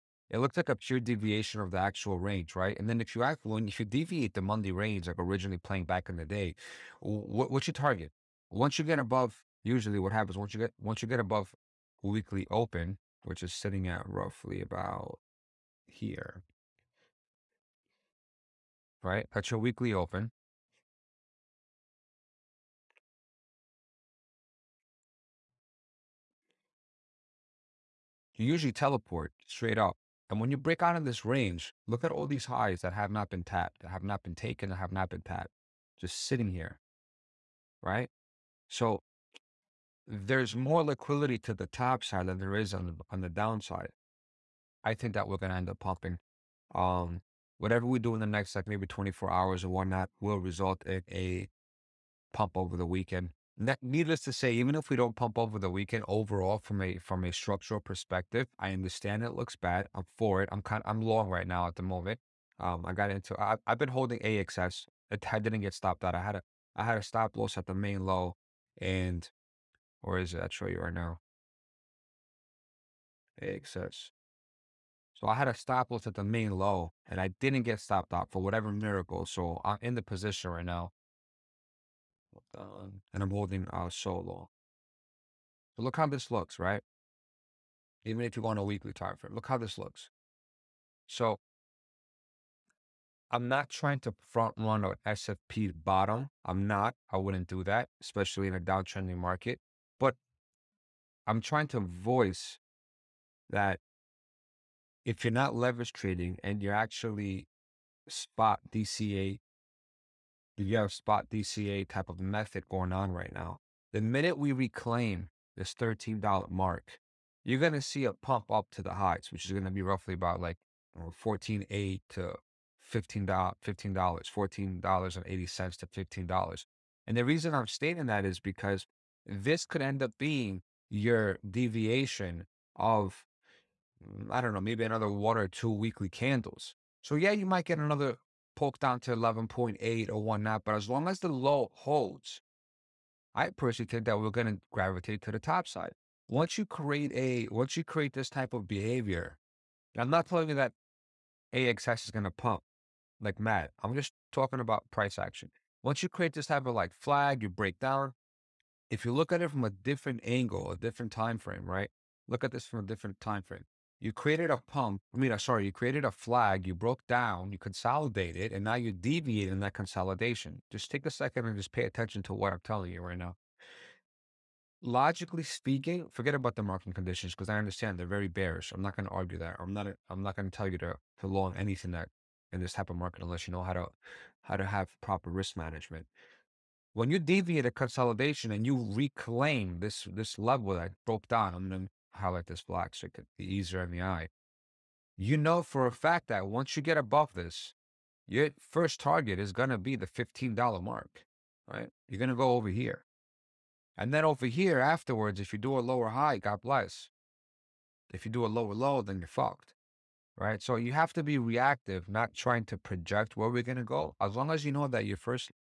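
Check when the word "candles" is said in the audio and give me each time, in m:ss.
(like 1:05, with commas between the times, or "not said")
2:16.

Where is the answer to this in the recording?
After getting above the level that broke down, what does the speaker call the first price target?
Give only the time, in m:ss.
3:19.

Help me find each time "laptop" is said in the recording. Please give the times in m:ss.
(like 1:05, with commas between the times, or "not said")
not said.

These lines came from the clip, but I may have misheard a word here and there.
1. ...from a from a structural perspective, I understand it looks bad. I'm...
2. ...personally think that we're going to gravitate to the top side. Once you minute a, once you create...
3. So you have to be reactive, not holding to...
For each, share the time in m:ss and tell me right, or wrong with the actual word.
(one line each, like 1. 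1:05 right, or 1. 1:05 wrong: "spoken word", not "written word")
1. 0:56 right
2. 2:23 wrong: "create", not "minute"
3. 3:30 wrong: "trying", not "holding".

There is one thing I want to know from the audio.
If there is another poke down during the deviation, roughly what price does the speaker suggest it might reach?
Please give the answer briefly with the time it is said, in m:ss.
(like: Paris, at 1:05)
11.8, at 2:19.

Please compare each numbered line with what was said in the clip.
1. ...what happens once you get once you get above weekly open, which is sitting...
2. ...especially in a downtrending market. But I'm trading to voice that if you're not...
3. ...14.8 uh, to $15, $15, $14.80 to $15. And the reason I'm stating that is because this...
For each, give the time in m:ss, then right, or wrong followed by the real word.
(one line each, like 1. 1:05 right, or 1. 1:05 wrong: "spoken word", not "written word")
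1. 0:09 right
2. 1:38 wrong: "trying", not "trading"
3. 2:00 right.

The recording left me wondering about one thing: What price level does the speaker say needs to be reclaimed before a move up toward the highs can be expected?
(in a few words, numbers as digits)
$13.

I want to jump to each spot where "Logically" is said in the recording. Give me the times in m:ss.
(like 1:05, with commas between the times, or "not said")
2:54.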